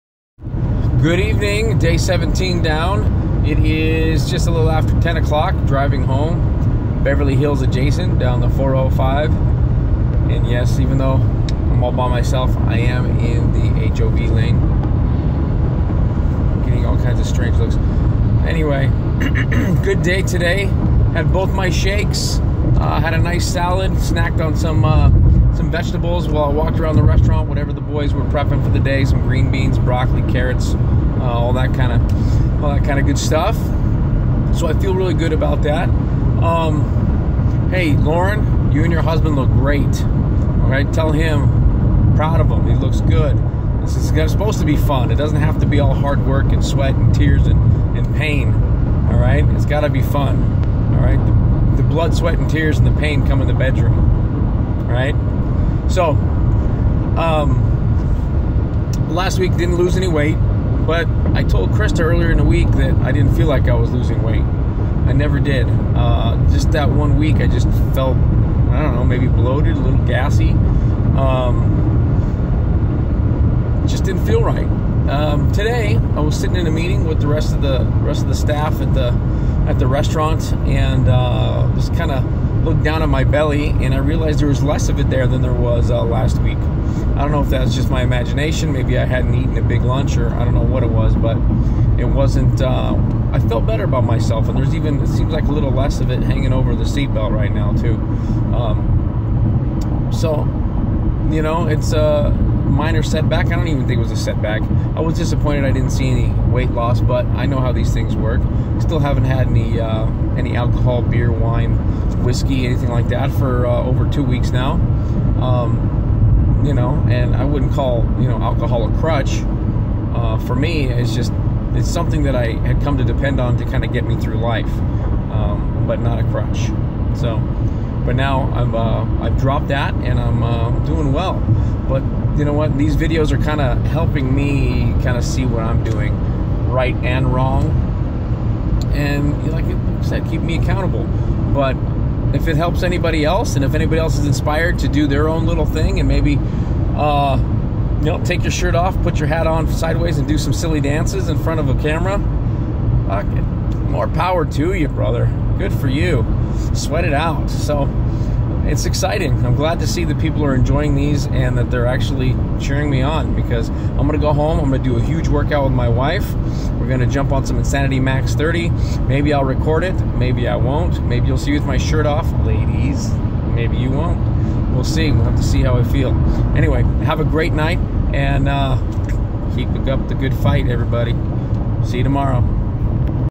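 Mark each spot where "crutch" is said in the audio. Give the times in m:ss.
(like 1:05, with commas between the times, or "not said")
1:58, 2:06.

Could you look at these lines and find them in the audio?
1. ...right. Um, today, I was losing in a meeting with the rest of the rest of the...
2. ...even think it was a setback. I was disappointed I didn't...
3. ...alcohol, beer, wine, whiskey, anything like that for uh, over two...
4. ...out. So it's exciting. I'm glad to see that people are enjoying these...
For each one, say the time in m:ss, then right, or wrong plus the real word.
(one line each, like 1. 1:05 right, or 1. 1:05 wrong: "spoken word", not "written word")
1. 1:14 wrong: "sitting", not "losing"
2. 1:43 right
3. 1:50 right
4. 2:37 right.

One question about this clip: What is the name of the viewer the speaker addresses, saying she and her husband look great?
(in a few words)
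Lauren.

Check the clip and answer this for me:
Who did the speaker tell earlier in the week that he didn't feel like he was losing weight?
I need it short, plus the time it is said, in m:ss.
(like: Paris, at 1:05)
Christa, at 1:01.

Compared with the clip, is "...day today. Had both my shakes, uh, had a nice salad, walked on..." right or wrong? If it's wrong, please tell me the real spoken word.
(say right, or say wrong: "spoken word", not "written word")
wrong: "snacked", not "walked".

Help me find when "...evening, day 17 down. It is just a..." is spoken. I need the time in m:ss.
0:01.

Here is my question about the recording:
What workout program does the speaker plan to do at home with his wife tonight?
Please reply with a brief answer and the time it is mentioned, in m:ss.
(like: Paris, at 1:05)
Insanity Max 30, at 2:47.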